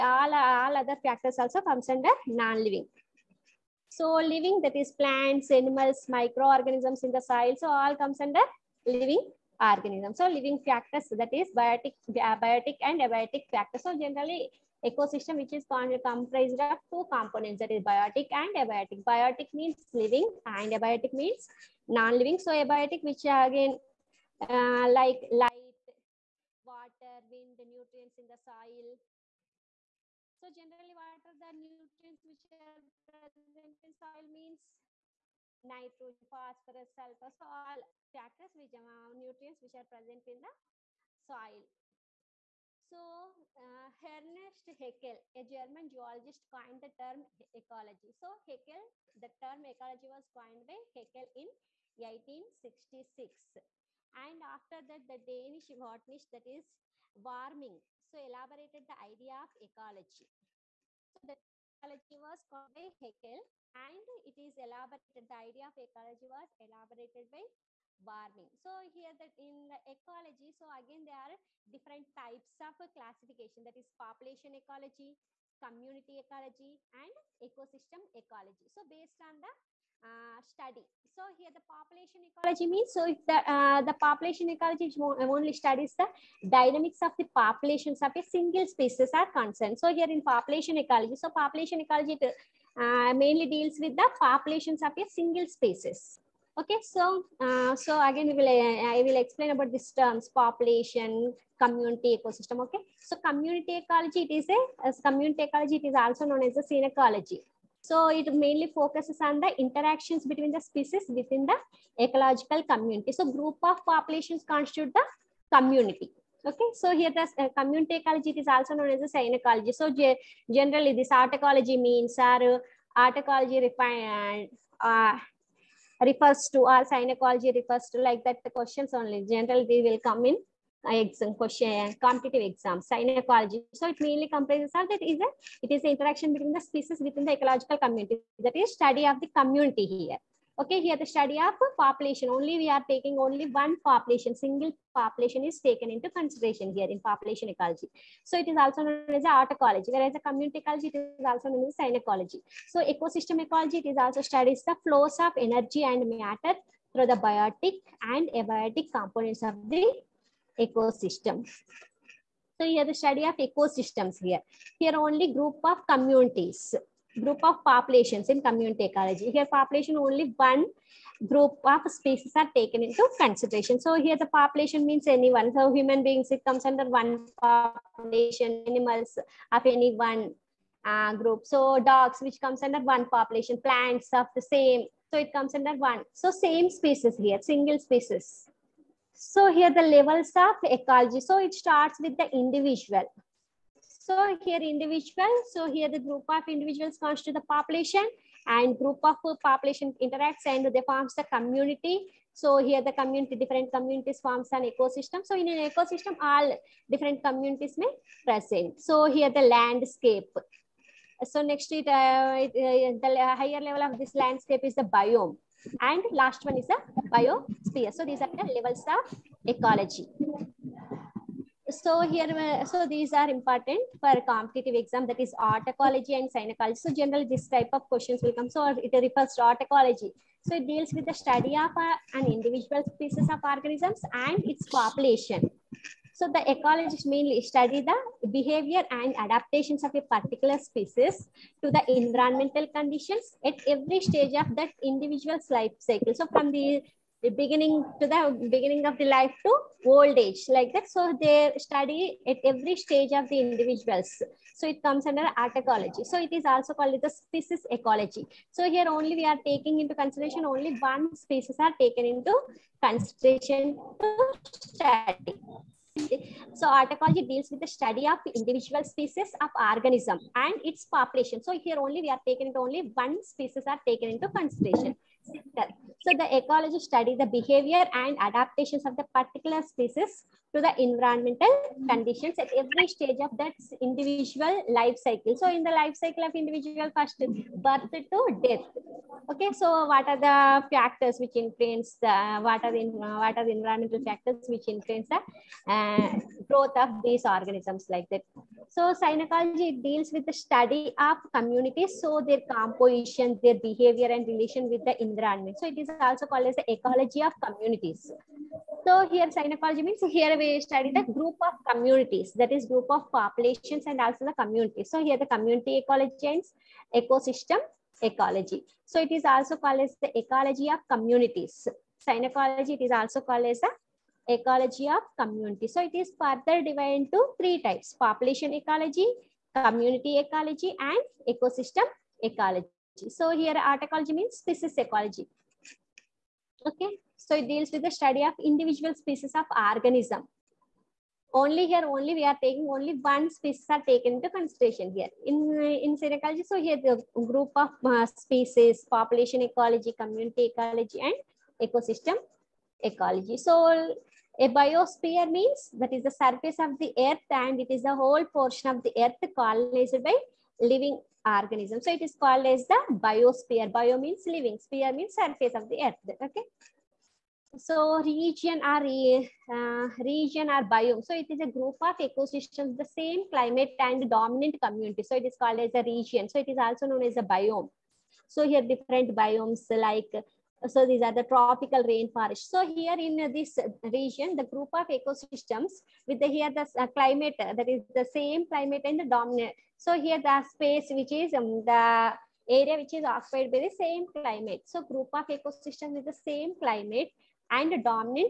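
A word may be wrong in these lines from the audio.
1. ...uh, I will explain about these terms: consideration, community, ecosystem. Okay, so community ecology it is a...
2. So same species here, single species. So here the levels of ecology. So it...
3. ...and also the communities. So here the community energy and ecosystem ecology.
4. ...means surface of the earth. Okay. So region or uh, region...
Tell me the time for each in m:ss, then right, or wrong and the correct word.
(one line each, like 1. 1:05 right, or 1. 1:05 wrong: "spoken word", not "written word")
1. 1:38 wrong: "population", not "consideration"
2. 3:06 right
3. 5:13 wrong: "ecology", not "energy"
4. 6:04 right.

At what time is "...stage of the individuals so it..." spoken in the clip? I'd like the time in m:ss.
4:12.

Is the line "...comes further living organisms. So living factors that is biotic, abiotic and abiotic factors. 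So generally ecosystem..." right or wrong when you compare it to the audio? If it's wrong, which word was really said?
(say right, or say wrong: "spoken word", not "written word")
wrong: "under", not "further".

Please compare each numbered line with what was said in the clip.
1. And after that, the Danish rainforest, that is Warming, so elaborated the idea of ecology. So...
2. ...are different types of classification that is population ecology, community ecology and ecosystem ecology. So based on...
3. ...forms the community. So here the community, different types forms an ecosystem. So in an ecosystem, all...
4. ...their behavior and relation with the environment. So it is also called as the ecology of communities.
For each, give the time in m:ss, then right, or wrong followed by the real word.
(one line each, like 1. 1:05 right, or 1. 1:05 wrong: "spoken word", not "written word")
1. 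0:54 wrong: "botanist", not "rainforest"
2. 1:11 right
3. 3:20 wrong: "communities", not "types"
4. 5:03 right.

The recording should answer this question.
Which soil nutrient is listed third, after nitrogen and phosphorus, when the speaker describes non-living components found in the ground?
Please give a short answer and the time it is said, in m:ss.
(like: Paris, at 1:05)
Sulfur, at 0:36.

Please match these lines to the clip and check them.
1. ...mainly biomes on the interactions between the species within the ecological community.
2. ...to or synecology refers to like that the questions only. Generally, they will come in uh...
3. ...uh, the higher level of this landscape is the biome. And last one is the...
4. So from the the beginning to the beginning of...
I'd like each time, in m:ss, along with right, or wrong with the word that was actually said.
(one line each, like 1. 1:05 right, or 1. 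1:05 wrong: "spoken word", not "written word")
1. 1:48 wrong: "focuses", not "biomes"
2. 2:06 right
3. 3:32 right
4. 4:06 right.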